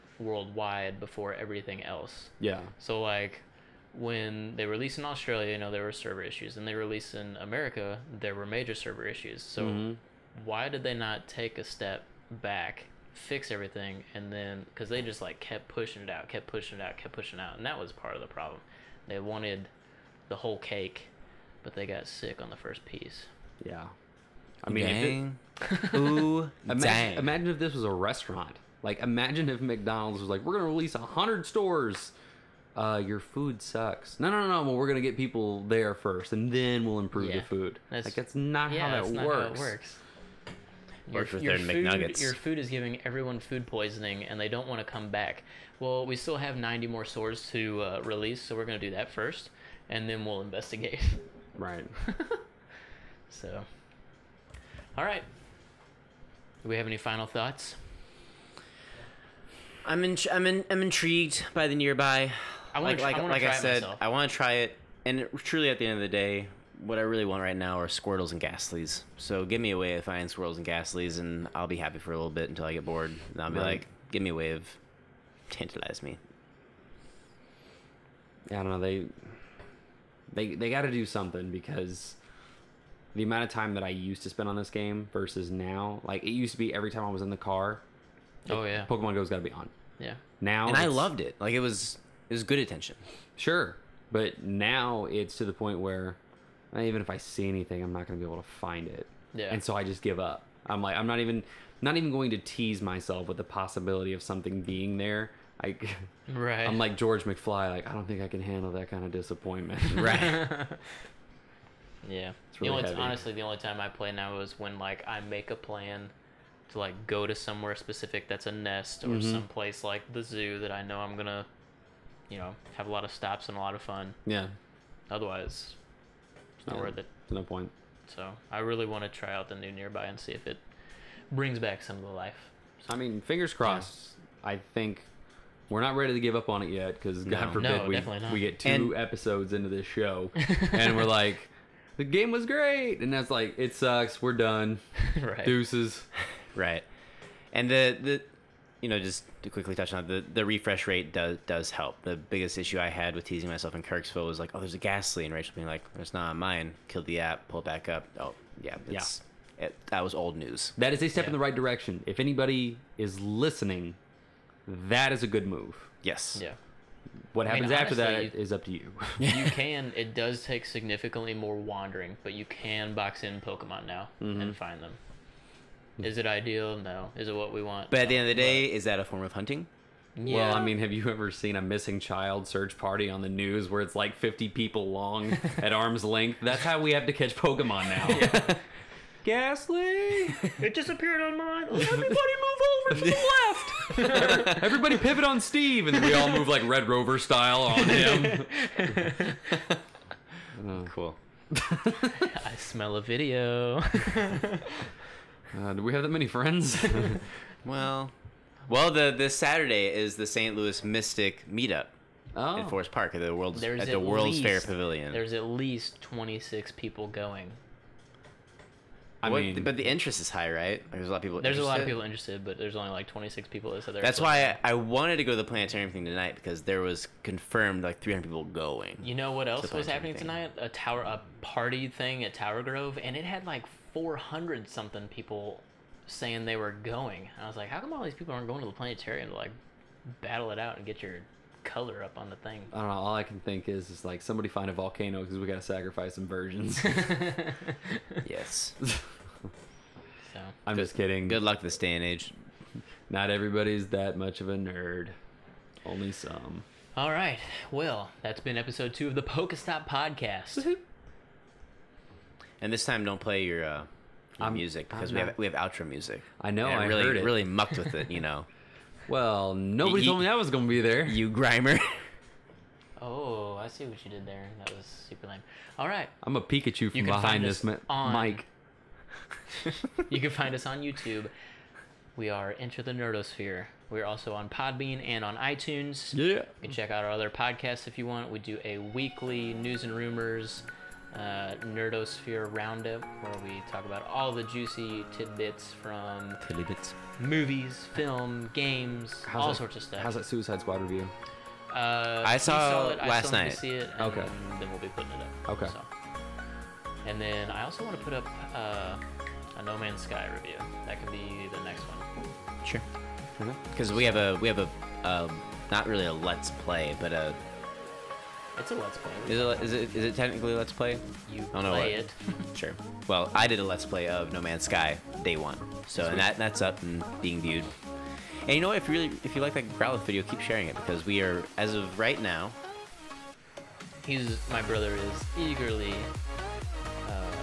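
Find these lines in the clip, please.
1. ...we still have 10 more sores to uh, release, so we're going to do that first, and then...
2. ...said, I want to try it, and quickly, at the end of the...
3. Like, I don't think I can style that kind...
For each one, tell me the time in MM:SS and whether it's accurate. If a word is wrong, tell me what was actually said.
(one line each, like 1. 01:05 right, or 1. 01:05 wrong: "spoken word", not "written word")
1. 00:46 wrong: "90", not "10"
2. 01:03 wrong: "truly", not "quickly"
3. 01:47 wrong: "handle", not "style".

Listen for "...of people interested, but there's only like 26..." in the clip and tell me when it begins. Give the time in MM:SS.
03:41.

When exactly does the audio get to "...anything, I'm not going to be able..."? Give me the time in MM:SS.
01:37.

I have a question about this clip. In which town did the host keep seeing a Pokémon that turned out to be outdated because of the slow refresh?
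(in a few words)
Kirksville.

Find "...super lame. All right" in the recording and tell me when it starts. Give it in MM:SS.
04:35.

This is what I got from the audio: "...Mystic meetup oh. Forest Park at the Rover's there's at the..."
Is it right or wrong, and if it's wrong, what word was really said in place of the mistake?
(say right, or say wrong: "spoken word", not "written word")
wrong: "World", not "Rover".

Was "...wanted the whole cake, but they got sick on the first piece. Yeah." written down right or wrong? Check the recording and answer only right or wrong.
right.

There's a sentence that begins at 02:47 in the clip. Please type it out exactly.
What I happens mean, after honestly, that is up to you.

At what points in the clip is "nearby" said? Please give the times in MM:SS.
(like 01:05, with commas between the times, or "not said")
01:01, 02:09.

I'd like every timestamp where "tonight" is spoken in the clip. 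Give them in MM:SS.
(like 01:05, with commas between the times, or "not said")
03:46, 03:50.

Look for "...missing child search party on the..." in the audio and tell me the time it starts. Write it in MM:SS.
03:01.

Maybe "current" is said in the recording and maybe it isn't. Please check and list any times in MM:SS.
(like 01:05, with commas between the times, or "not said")
not said.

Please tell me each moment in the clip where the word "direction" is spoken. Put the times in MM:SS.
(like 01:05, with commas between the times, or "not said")
02:41.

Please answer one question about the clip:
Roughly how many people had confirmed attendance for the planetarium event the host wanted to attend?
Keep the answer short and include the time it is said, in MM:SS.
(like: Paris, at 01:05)
300, at 03:48.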